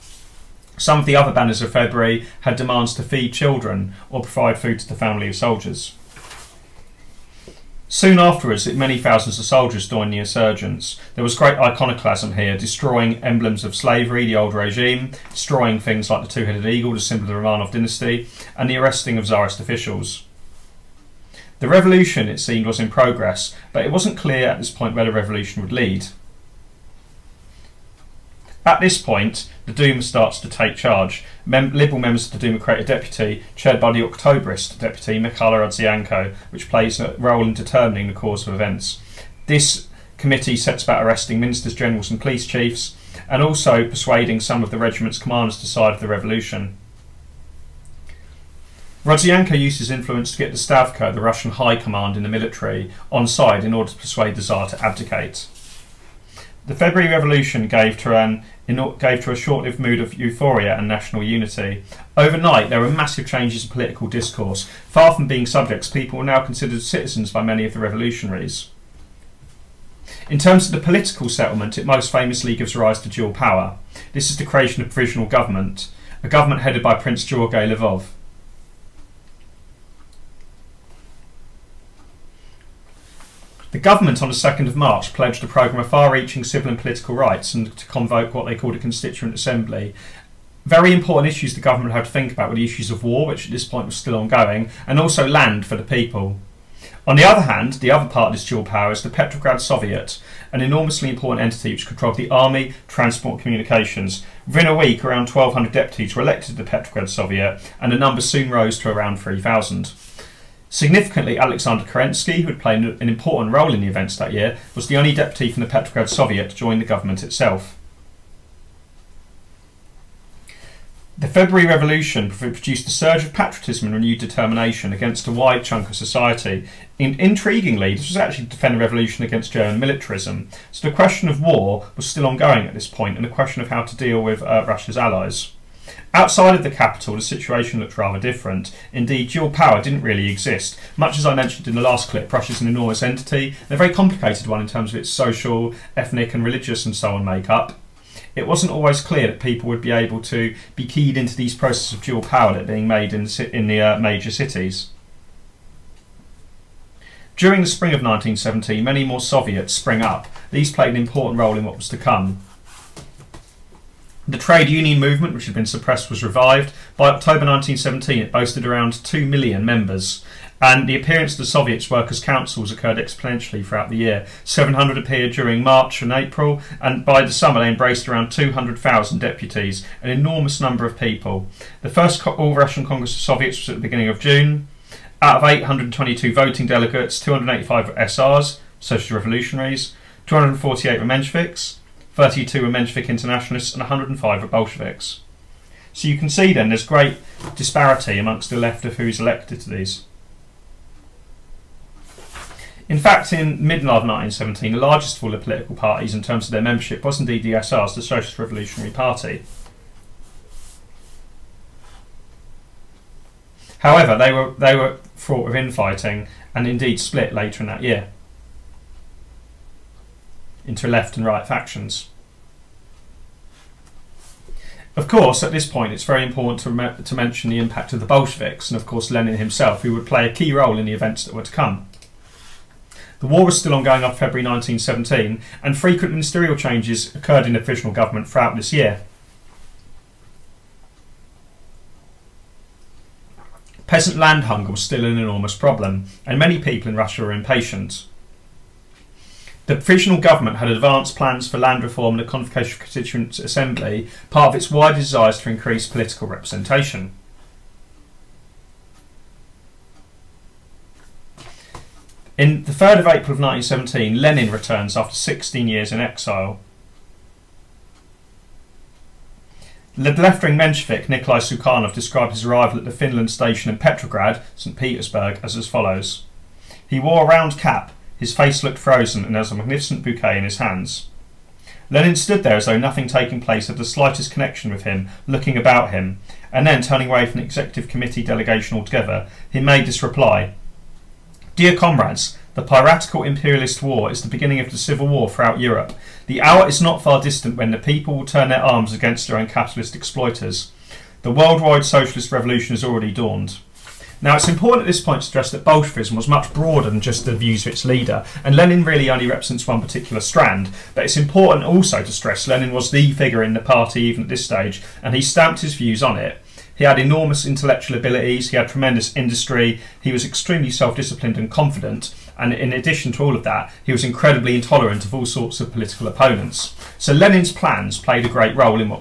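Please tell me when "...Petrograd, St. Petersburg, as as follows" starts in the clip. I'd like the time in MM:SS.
04:33.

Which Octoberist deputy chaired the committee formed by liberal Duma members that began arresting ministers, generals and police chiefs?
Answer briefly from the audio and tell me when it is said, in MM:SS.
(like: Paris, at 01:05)
Mikhailo Rodzianko, at 00:35.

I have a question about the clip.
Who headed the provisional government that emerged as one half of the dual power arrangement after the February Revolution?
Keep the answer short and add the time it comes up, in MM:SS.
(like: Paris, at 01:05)
Prince George Lvov, at 01:16.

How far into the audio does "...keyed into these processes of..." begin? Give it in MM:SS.
02:30.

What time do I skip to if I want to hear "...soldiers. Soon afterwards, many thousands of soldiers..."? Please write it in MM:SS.
00:05.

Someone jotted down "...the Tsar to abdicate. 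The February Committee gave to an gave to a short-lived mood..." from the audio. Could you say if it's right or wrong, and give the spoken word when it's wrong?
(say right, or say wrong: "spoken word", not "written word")
wrong: "Revolution", not "Committee".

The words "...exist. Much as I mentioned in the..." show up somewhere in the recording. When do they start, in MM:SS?
02:20.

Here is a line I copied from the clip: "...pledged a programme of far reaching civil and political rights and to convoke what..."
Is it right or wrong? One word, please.
right.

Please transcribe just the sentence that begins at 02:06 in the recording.
intriguingly, this was actually to defend the revolution against German militarism.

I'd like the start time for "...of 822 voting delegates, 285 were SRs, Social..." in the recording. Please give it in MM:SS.
03:05.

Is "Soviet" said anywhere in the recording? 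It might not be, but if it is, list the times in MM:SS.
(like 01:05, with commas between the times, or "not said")
01:39, 01:47, 01:56, 02:39, 02:51, 03:03.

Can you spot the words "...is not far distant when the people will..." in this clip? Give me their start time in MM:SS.
04:56.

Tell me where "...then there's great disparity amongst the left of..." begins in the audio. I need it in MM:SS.
03:16.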